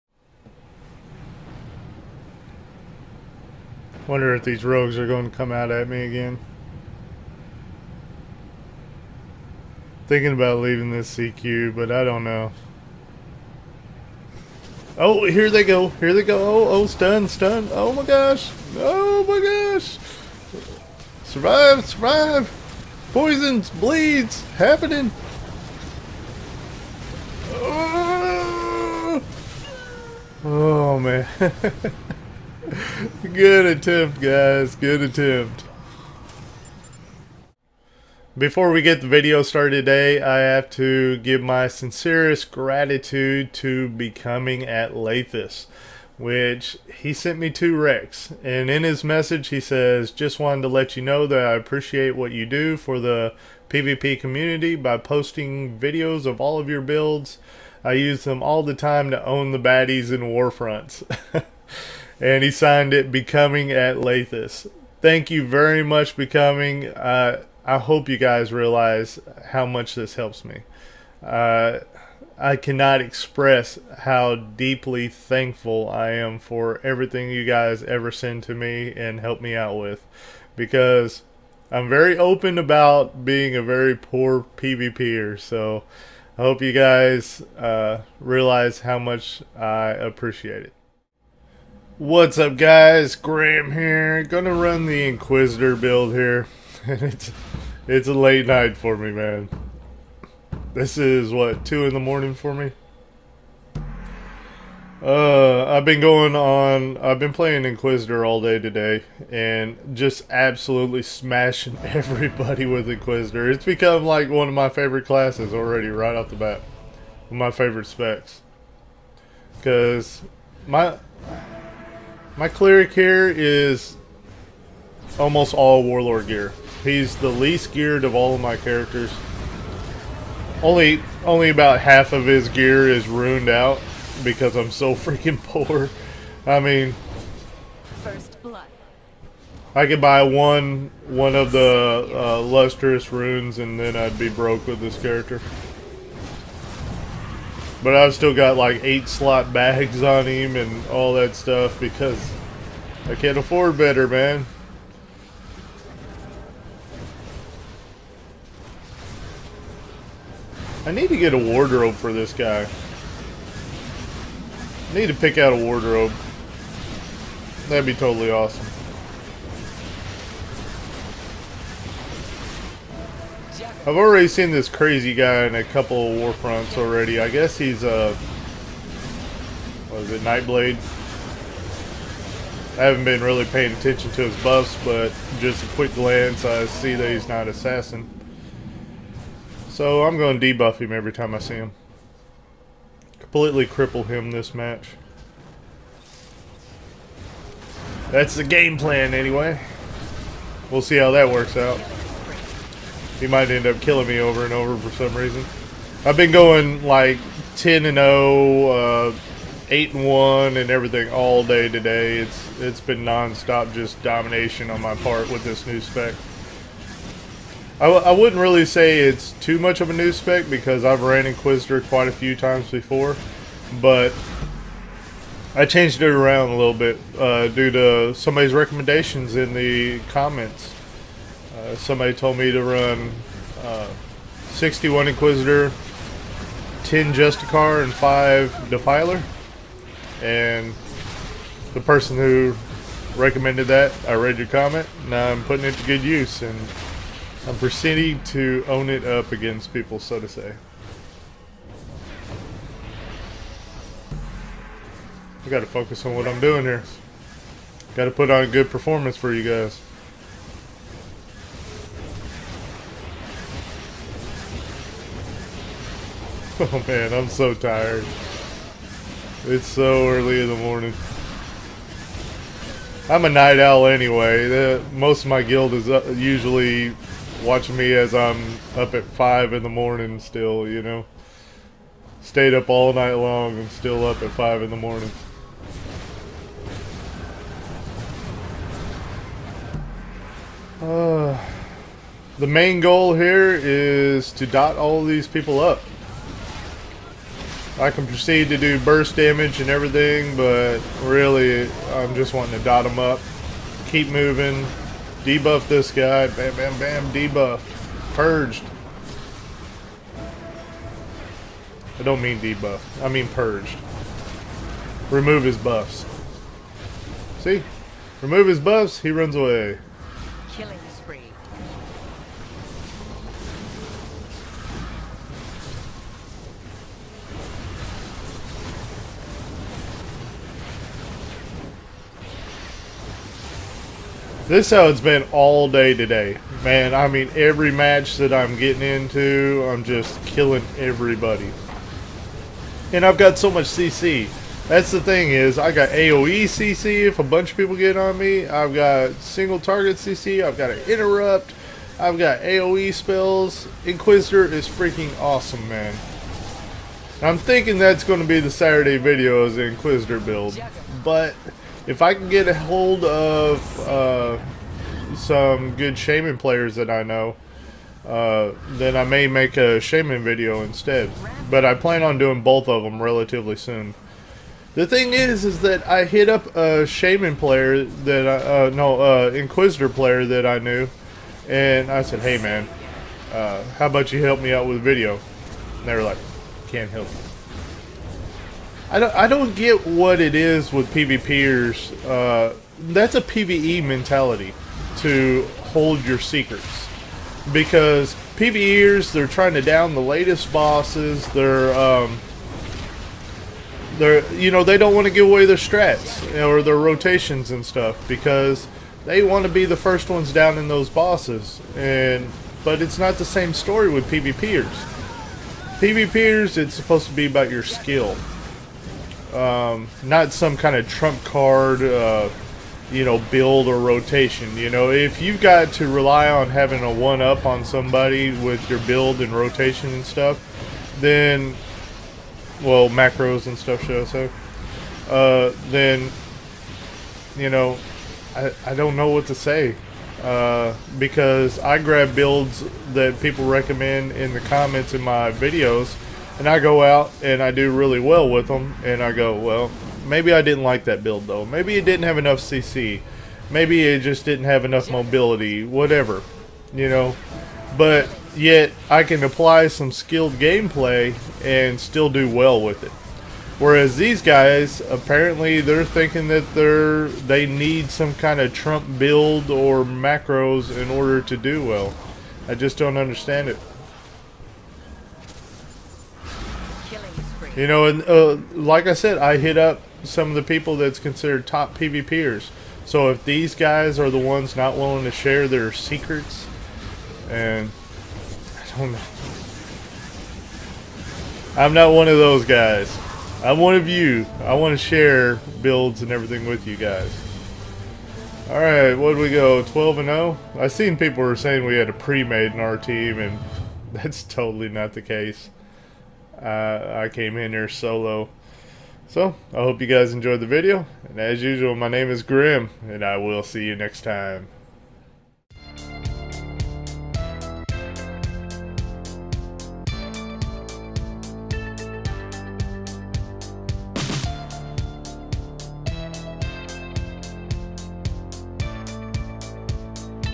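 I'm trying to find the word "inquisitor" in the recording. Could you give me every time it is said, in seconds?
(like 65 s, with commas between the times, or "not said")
95 s, 107 s, 112 s, 221 s, 235 s, 353 s, 359 s, 379 s.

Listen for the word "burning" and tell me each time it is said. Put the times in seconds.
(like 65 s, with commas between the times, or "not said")
not said.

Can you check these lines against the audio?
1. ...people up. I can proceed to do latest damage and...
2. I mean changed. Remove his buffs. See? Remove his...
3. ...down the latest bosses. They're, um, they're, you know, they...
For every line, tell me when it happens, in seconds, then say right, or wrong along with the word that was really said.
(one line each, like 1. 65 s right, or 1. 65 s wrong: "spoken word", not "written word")
1. 295 s wrong: "burst", not "latest"
2. 313 s wrong: "purged", not "changed"
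3. 399 s right.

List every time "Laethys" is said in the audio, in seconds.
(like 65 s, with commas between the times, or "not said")
44 s, 63 s.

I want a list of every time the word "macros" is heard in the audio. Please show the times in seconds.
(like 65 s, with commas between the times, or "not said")
432 s, 469 s.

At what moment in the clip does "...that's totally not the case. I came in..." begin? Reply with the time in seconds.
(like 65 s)
503 s.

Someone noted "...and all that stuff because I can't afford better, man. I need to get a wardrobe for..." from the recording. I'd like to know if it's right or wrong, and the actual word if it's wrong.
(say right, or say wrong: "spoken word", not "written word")
right.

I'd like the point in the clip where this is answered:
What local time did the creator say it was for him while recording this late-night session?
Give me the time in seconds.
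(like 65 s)
101 s.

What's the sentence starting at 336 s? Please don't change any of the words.
Man, I mean, every match that I'm getting into, I'm just killing everybody.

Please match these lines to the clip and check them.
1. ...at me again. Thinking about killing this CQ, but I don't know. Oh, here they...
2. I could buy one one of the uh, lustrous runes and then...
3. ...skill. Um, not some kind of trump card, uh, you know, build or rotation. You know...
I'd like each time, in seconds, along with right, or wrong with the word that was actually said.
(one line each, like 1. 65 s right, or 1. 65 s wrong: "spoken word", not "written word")
1. 5 s wrong: "leaving", not "killing"
2. 139 s right
3. 417 s right.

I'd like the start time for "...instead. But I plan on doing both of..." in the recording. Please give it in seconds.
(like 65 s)
370 s.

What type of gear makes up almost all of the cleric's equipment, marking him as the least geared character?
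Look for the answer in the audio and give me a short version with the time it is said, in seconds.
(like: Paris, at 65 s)
Warlord gear, at 125 s.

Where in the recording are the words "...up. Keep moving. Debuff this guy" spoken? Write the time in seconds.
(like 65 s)
302 s.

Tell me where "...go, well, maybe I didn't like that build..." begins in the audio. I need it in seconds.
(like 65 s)
449 s.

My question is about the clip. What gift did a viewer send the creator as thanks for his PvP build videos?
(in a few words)
2 REX.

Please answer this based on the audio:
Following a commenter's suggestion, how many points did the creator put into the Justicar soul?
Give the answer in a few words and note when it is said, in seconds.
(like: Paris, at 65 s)
10, at 236 s.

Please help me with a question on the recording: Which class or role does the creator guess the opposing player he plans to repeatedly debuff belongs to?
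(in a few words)
Nightblade.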